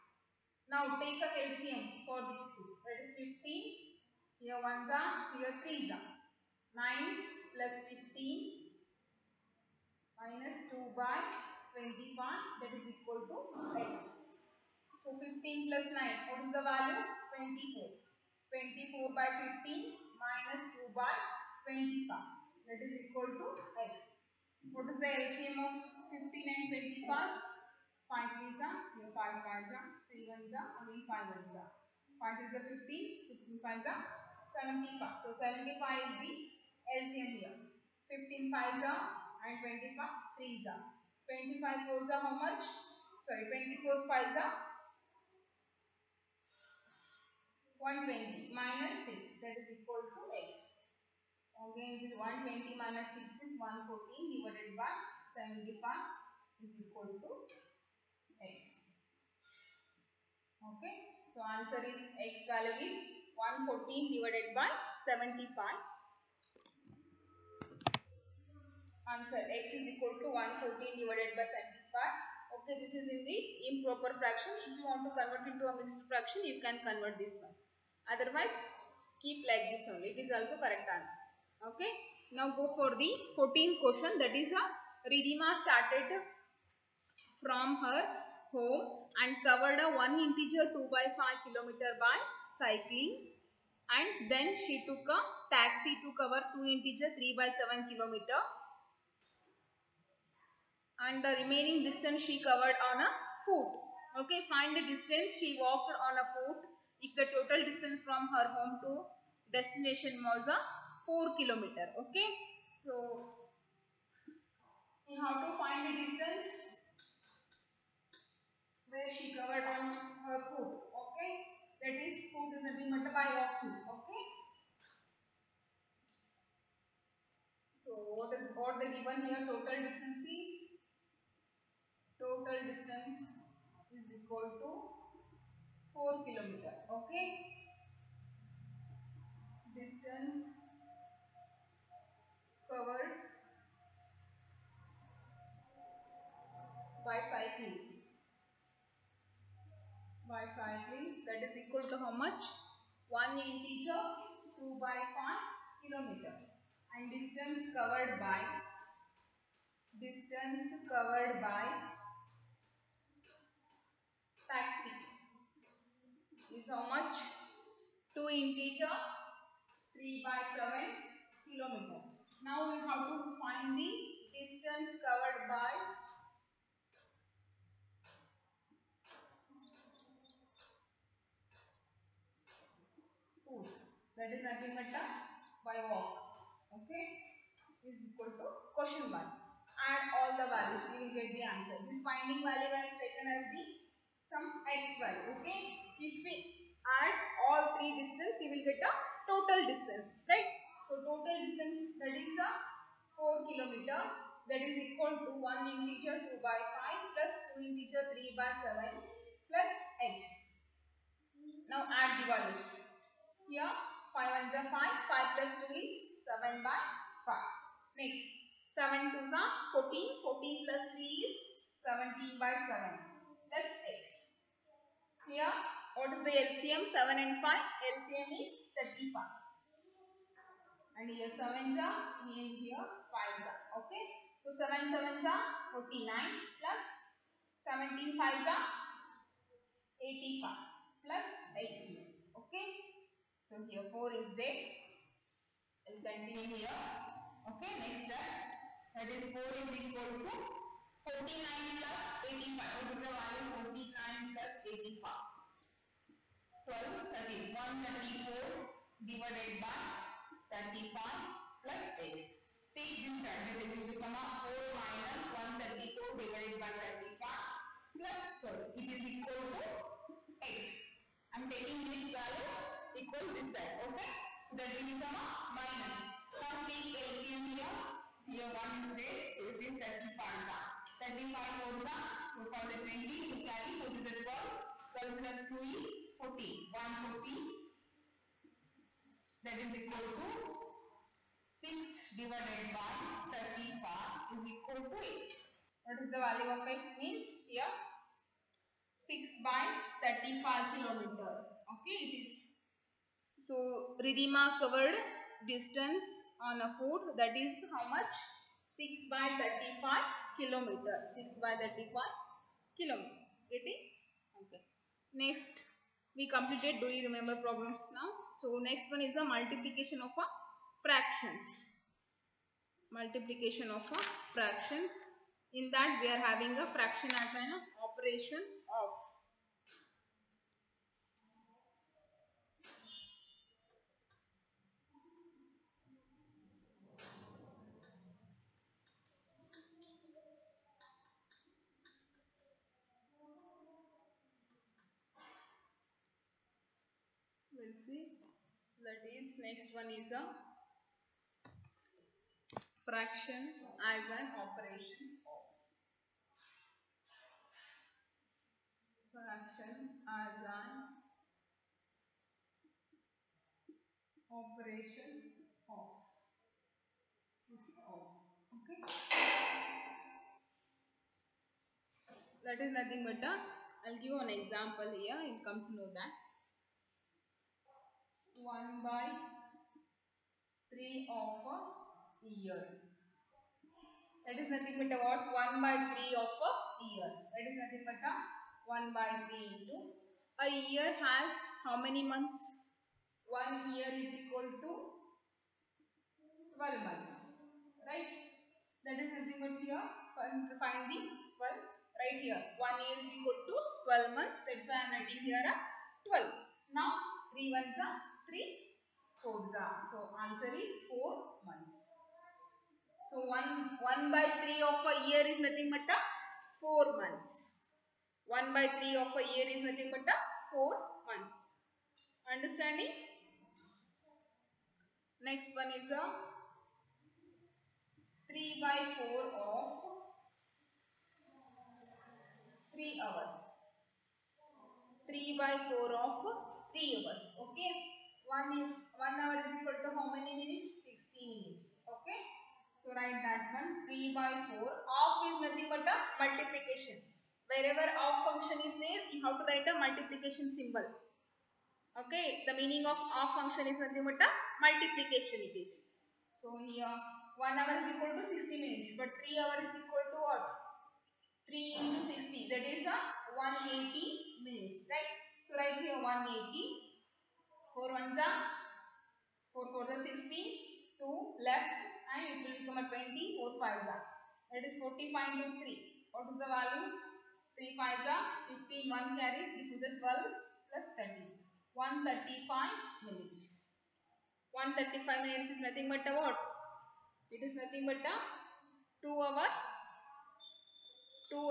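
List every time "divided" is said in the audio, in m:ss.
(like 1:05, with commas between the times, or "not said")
0:54, 1:04, 1:10, 4:19, 4:26, 4:52.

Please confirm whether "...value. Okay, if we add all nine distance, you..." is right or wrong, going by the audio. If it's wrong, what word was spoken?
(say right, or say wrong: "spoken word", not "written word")
wrong: "three", not "nine".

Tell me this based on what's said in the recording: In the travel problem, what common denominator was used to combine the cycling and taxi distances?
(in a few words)
35.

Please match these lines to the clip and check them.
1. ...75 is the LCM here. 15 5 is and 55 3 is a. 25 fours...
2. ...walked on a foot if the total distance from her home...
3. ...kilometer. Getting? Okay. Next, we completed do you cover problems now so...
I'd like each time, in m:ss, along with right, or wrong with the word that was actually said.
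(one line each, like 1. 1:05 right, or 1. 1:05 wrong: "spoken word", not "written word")
1. 0:35 wrong: "25", not "55"
2. 1:45 right
3. 5:12 wrong: "remember", not "cover".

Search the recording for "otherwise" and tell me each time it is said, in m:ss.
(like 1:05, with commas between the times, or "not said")
1:18.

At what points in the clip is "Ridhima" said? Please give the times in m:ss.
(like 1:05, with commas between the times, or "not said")
1:25, 5:04.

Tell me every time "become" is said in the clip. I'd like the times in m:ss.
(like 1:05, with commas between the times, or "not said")
4:23, 4:34, 7:52.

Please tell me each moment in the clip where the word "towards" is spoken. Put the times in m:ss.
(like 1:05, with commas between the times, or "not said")
not said.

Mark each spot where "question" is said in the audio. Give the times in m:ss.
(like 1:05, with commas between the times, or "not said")
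1:23, 3:08.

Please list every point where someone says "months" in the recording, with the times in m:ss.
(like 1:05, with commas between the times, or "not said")
6:32, 6:36, 6:44, 6:51, 6:57, 7:01.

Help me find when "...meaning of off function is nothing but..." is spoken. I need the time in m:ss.
7:32.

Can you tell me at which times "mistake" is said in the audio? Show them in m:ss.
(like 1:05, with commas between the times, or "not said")
not said.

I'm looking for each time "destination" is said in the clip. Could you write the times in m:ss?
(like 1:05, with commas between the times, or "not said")
1:49.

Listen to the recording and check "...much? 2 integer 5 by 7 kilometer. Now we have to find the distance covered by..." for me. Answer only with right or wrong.
wrong.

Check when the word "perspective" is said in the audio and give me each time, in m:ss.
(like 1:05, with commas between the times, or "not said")
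not said.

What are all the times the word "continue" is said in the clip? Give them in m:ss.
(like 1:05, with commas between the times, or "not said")
4:06.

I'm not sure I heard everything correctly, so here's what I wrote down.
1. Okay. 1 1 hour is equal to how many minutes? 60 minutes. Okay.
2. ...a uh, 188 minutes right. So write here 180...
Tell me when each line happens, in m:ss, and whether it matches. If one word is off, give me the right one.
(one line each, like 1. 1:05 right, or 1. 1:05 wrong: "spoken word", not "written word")
1. 7:17 right
2. 7:42 wrong: "180", not "188".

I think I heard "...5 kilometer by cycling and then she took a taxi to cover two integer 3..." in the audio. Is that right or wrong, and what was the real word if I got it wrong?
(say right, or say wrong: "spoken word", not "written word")
right.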